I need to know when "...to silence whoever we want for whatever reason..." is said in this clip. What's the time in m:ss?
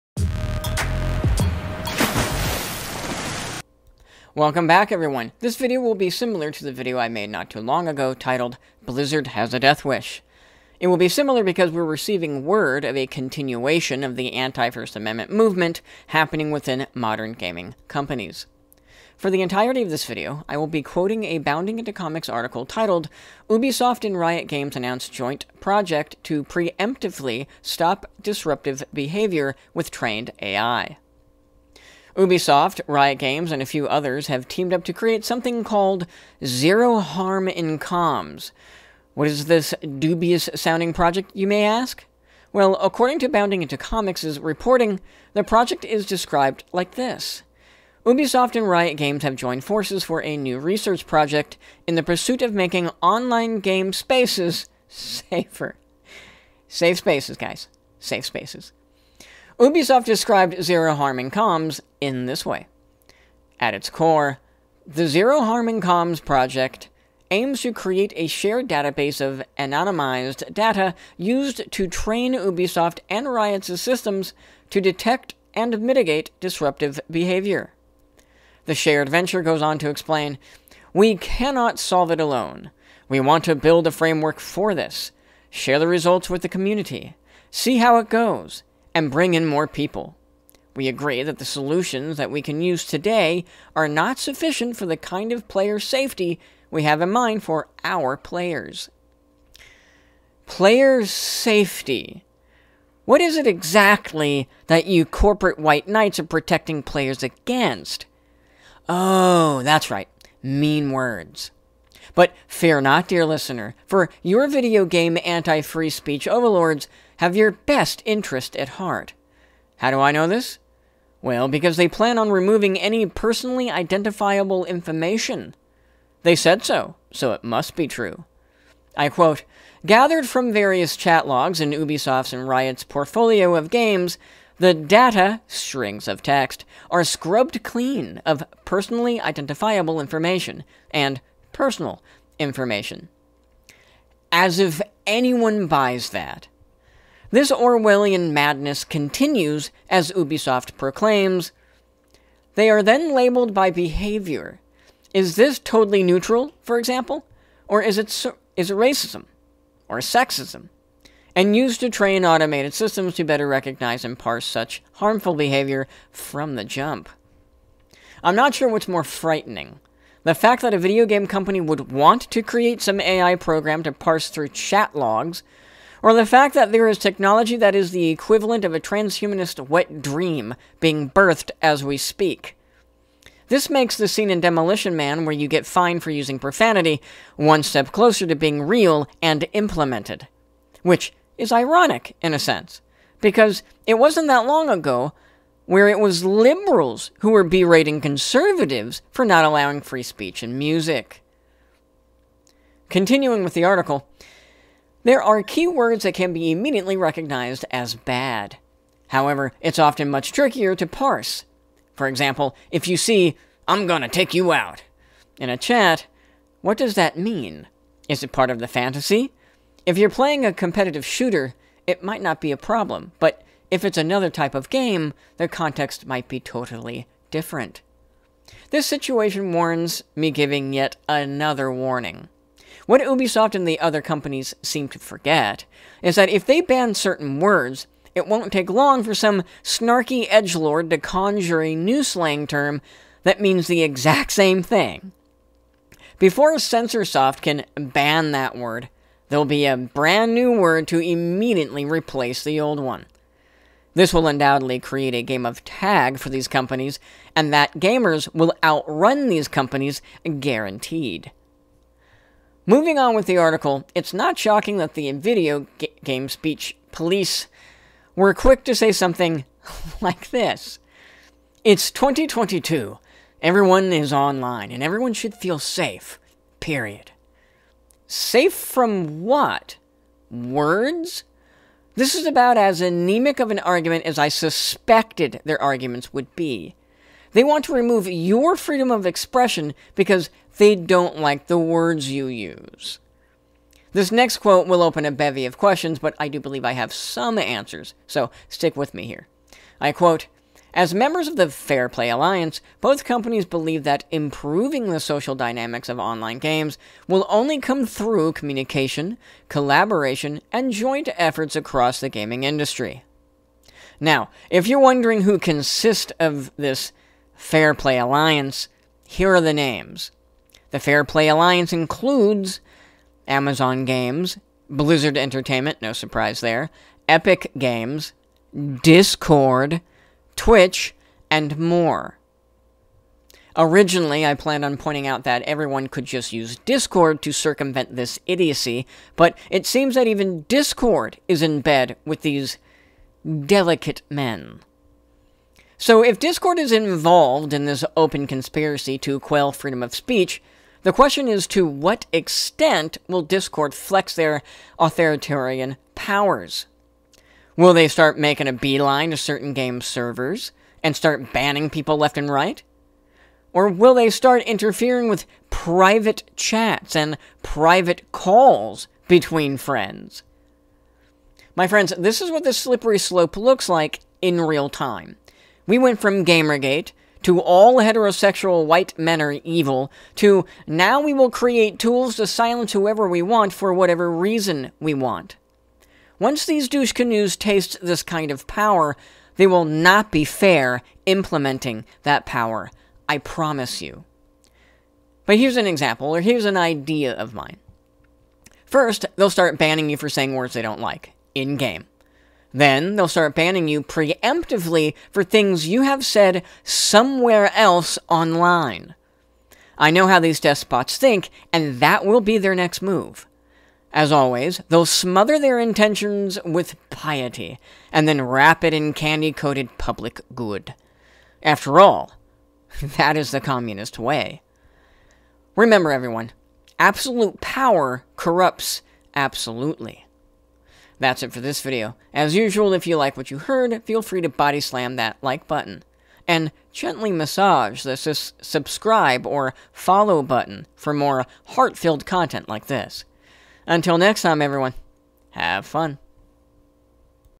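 6:22.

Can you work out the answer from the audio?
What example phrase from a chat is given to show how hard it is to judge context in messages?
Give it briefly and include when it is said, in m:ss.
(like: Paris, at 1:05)
I'm gonna take you out, at 3:33.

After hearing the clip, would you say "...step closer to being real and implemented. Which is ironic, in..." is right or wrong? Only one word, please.
right.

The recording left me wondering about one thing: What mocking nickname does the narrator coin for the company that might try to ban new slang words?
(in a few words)
Censorsoft.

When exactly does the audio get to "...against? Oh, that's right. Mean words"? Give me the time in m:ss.
1:47.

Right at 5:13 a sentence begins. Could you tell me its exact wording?
Now, if you're wondering who consists of this Fair Play Alliance, here are the names.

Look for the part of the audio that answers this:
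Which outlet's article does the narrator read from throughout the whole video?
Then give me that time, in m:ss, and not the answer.
0:21.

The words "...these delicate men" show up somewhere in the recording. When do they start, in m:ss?
5:42.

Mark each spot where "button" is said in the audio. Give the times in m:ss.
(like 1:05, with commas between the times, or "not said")
7:15, 7:20.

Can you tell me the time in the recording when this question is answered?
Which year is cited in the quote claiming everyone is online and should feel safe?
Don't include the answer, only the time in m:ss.
4:31.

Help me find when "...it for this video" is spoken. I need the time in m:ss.
7:11.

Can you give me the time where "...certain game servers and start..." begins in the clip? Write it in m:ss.
5:59.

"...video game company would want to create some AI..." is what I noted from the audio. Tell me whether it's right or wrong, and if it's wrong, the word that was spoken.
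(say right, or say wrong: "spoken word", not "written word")
right.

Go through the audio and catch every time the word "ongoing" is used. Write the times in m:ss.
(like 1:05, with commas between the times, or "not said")
not said.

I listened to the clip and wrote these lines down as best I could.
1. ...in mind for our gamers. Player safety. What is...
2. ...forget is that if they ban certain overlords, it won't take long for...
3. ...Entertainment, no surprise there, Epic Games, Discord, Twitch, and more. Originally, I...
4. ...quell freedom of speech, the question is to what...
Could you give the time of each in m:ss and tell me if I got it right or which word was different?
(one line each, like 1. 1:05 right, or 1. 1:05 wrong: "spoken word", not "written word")
1. 1:37 wrong: "players", not "gamers"
2. 3:54 wrong: "words", not "overlords"
3. 5:25 right
4. 5:49 right.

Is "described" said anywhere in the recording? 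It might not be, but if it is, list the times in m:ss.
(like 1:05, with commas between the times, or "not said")
0:46, 1:00.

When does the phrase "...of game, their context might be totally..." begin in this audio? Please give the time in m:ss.
3:44.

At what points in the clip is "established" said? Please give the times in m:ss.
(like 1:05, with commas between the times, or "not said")
not said.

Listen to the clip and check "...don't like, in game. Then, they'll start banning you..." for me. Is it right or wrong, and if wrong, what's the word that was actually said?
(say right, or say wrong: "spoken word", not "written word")
right.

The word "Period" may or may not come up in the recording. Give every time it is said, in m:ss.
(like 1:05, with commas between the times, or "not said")
4:36.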